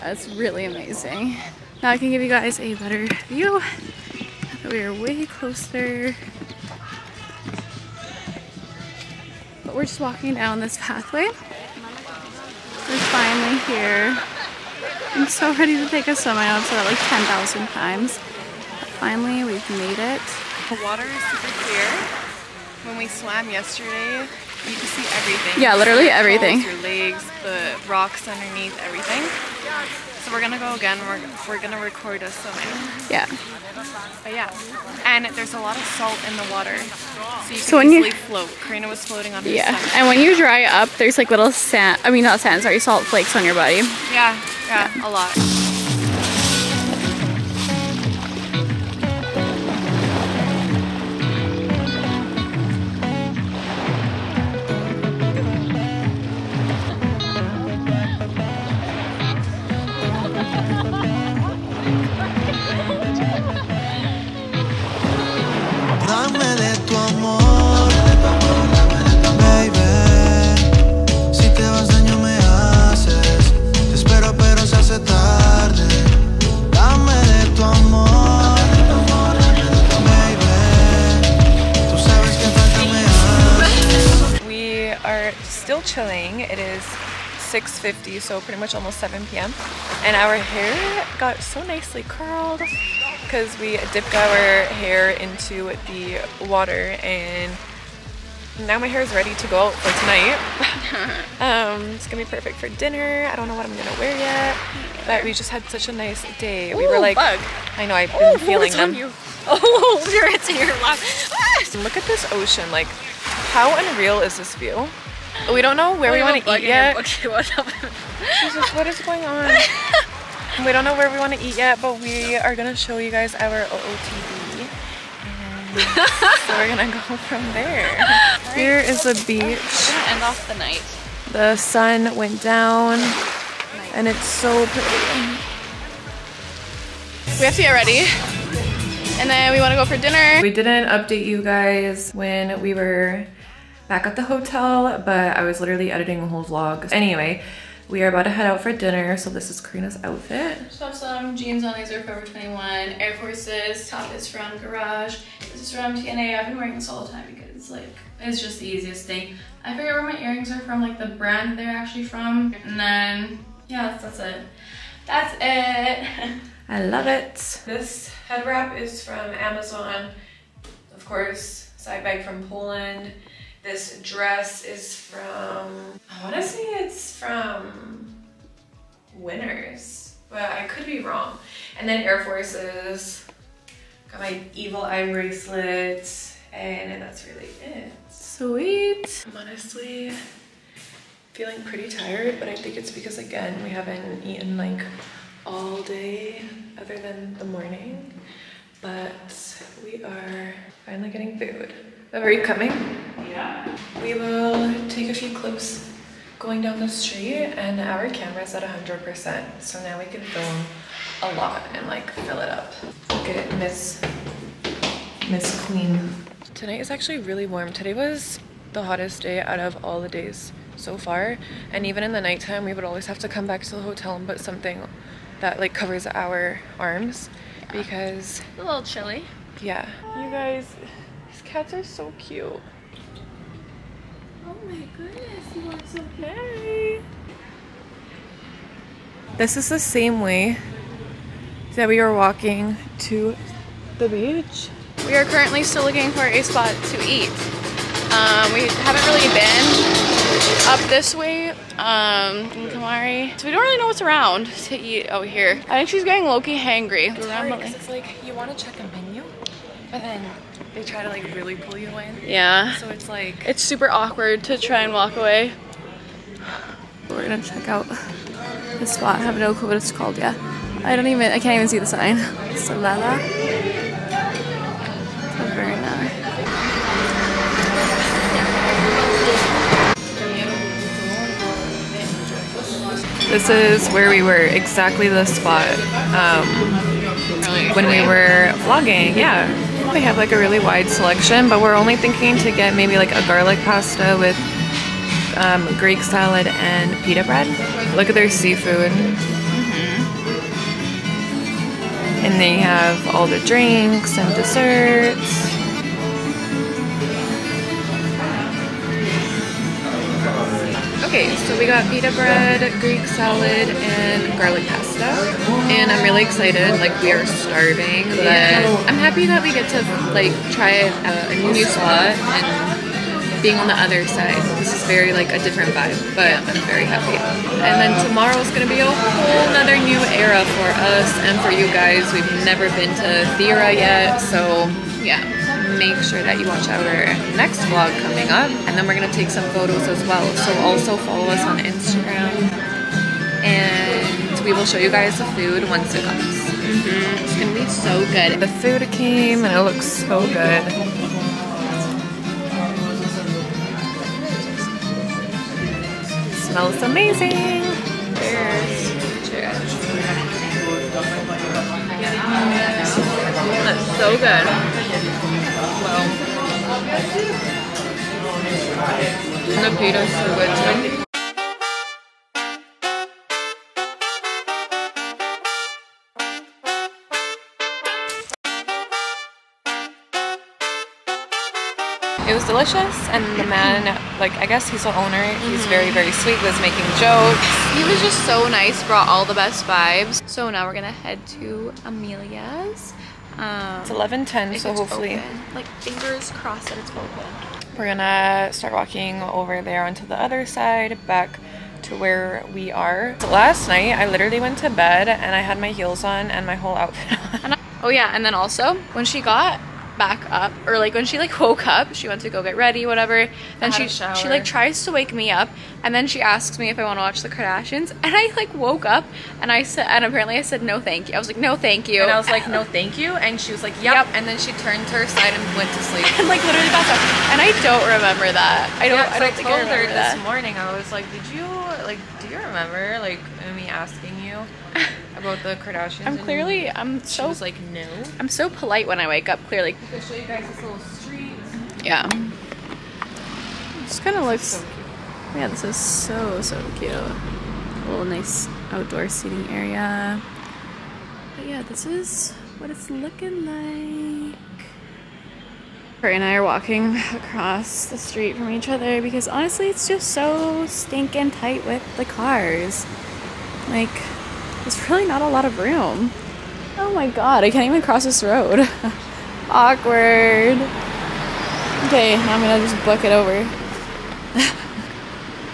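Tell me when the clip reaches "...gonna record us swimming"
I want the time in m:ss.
0:31.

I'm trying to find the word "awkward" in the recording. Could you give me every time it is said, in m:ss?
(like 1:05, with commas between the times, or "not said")
4:23, 7:49.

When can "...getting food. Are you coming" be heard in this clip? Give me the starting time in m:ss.
3:21.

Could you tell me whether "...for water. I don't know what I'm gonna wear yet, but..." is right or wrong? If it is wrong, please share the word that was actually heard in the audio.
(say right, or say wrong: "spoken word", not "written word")
wrong: "dinner", not "water".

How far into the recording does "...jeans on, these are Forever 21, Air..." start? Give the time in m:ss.
2:31.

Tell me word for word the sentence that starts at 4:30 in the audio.
I don't even I can't even see the sign.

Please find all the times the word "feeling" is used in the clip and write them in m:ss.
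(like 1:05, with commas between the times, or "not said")
1:48, 3:11.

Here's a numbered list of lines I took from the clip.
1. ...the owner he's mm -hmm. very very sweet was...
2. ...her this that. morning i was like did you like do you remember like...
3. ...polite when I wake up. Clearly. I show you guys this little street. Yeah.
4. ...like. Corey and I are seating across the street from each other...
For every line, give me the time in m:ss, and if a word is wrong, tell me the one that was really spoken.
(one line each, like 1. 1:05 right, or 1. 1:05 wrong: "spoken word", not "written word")
1. 6:24 right
2. 7:09 right
3. 7:18 right
4. 7:33 wrong: "walking", not "seating".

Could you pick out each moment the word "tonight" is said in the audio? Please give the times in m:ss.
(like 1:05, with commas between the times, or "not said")
1:39, 3:36.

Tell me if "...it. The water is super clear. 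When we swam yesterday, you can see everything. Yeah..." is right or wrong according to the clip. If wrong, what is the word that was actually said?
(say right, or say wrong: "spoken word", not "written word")
right.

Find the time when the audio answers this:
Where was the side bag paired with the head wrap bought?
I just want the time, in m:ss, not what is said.
2:52.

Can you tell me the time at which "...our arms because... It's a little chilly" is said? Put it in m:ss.
3:46.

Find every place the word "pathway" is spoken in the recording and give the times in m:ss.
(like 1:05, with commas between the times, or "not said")
0:10.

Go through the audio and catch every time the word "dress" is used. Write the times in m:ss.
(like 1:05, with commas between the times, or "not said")
2:54.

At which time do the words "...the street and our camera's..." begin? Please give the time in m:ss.
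3:26.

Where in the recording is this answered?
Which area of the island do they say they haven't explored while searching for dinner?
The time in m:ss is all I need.
4:12.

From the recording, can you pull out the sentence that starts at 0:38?
Karina was floating on her Yeah, stomach.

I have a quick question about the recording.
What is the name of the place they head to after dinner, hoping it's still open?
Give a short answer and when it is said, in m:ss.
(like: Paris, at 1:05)
Amelia's, at 6:31.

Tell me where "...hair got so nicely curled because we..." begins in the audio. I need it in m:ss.
1:30.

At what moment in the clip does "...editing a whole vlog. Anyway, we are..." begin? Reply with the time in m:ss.
2:25.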